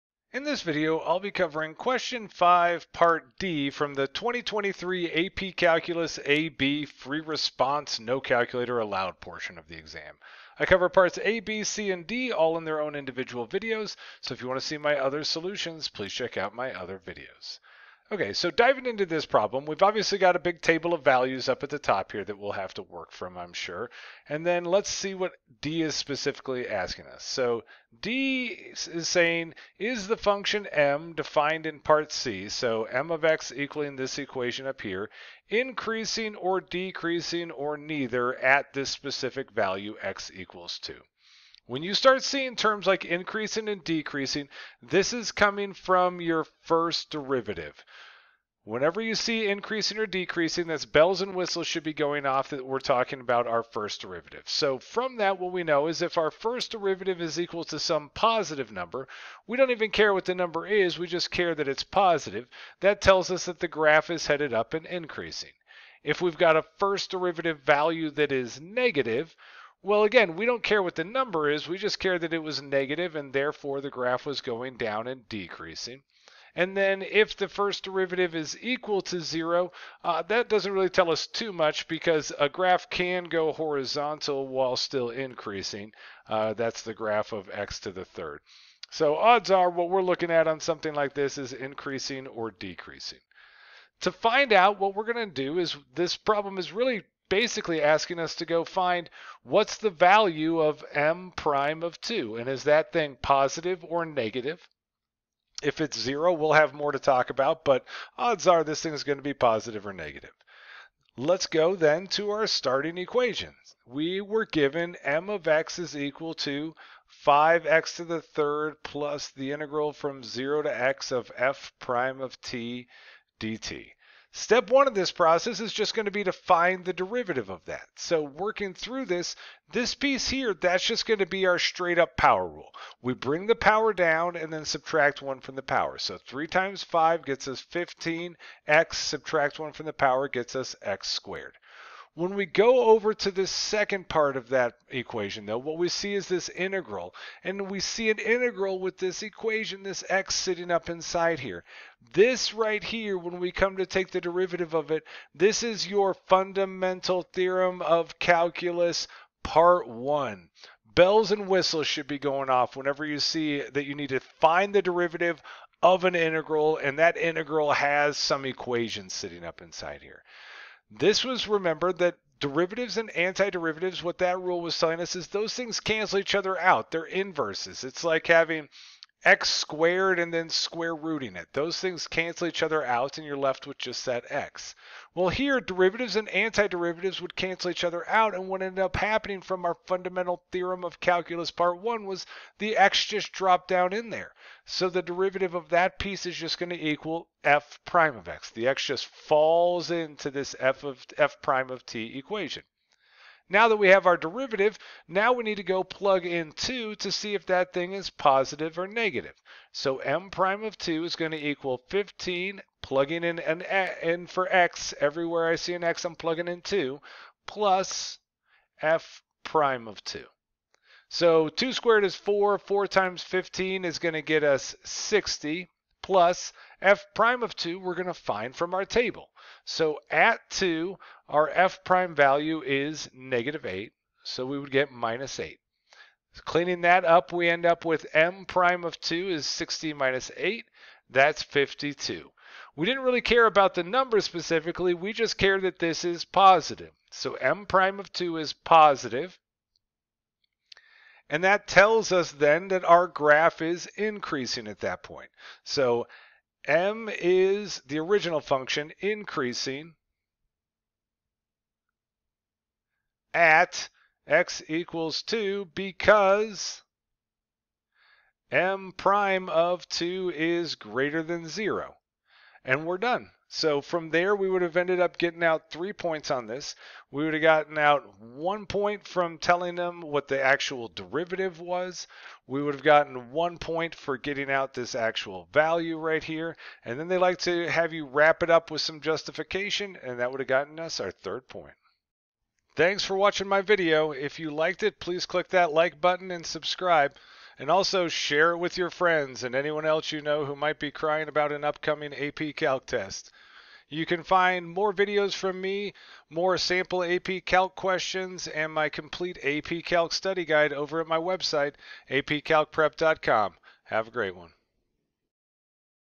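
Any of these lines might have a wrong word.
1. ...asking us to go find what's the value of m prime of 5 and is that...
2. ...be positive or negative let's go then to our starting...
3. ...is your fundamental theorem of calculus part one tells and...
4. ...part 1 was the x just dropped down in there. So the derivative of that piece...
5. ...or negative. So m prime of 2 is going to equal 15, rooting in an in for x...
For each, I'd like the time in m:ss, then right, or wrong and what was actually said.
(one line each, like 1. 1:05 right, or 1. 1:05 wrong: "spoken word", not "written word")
1. 1:37 wrong: "2", not "5"
2. 1:49 right
3. 2:35 wrong: "bells", not "tells"
4. 3:11 right
5. 3:28 wrong: "plugging", not "rooting".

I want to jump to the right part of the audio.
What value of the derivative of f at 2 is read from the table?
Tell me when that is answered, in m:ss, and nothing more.
3:53.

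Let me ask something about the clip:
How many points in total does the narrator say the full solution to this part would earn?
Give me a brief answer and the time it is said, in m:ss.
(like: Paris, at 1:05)
3, at 4:35.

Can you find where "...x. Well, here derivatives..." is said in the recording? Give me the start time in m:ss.
3:04.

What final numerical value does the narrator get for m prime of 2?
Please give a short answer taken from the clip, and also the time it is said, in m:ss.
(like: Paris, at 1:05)
52, at 4:01.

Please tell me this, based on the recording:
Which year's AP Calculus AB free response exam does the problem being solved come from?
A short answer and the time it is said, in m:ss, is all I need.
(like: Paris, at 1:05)
2023, at 0:04.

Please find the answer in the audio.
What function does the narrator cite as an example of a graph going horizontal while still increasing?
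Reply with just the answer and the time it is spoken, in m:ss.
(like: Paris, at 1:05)
x to the third, at 1:27.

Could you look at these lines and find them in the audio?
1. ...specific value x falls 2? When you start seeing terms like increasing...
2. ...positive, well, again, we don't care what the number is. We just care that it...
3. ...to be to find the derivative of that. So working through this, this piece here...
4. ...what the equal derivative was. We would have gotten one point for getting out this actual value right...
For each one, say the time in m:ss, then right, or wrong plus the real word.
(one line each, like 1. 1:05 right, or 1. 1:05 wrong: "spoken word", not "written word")
1. 0:38 wrong: "equals", not "falls"
2. 1:08 wrong: "negative", not "positive"
3. 2:06 right
4. 4:39 wrong: "actual", not "equal".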